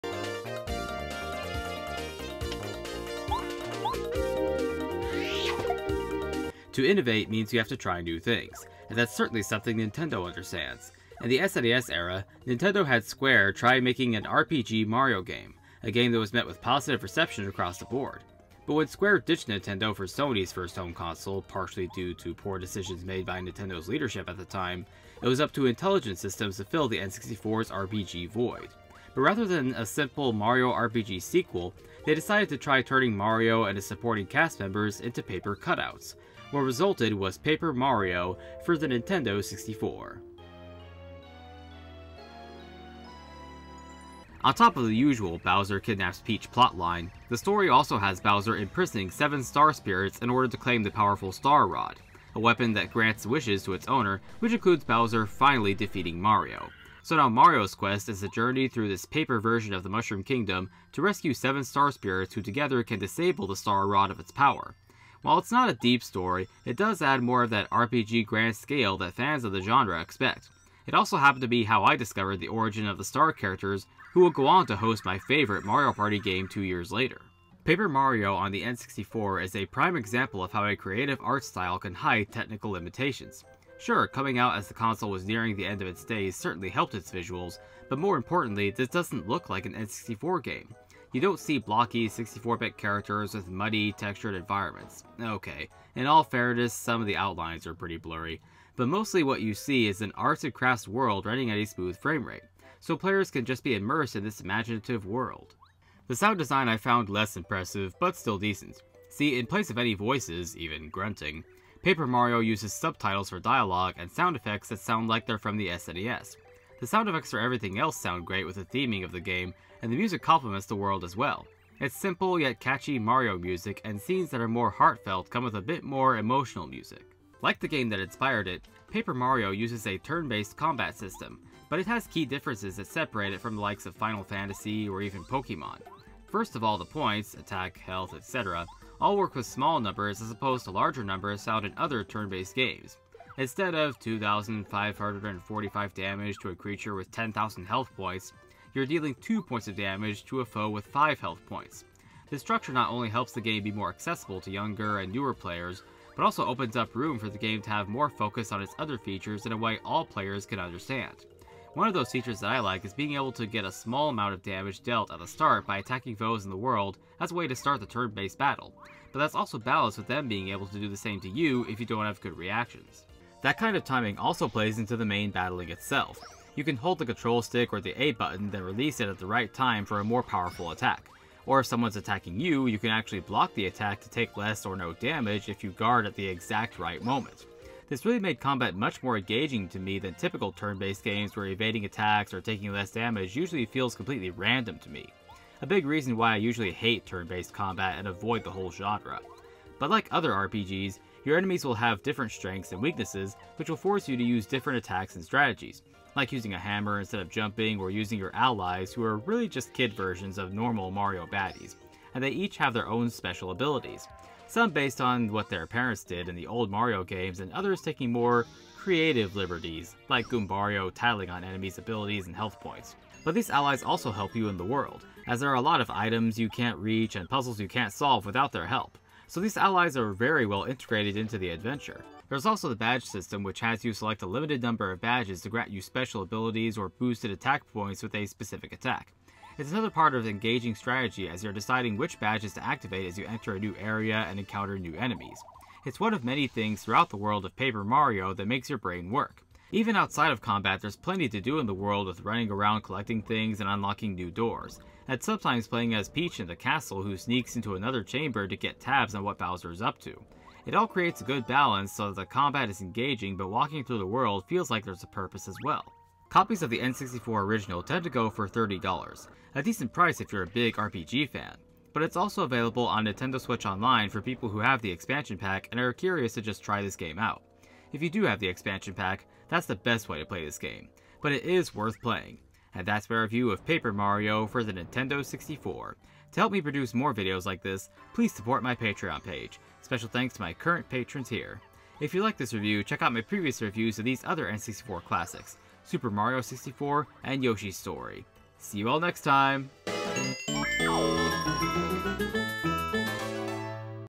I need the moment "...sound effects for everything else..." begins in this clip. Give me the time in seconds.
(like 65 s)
116 s.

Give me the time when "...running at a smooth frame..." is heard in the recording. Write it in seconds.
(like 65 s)
101 s.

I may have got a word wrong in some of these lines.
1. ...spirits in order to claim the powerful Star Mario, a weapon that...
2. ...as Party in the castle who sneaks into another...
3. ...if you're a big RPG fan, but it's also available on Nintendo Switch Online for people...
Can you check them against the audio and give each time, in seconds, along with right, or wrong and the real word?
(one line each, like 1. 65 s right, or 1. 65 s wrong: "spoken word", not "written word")
1. 49 s wrong: "Rod", not "Mario"
2. 255 s wrong: "Peach", not "Party"
3. 270 s right.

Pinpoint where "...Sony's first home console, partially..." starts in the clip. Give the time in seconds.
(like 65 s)
20 s.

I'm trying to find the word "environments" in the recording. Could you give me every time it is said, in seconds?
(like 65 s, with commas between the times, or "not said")
94 s.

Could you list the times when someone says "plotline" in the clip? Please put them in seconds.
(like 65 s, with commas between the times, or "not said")
46 s.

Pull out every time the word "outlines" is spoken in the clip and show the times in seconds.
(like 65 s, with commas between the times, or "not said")
97 s.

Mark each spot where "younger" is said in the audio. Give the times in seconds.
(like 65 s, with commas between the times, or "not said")
154 s.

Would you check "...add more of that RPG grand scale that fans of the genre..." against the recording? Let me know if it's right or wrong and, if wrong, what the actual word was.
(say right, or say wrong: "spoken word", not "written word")
right.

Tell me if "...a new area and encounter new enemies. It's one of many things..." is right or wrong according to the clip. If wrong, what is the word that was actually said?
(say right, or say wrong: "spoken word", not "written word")
right.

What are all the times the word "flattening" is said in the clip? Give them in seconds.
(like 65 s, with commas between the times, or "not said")
not said.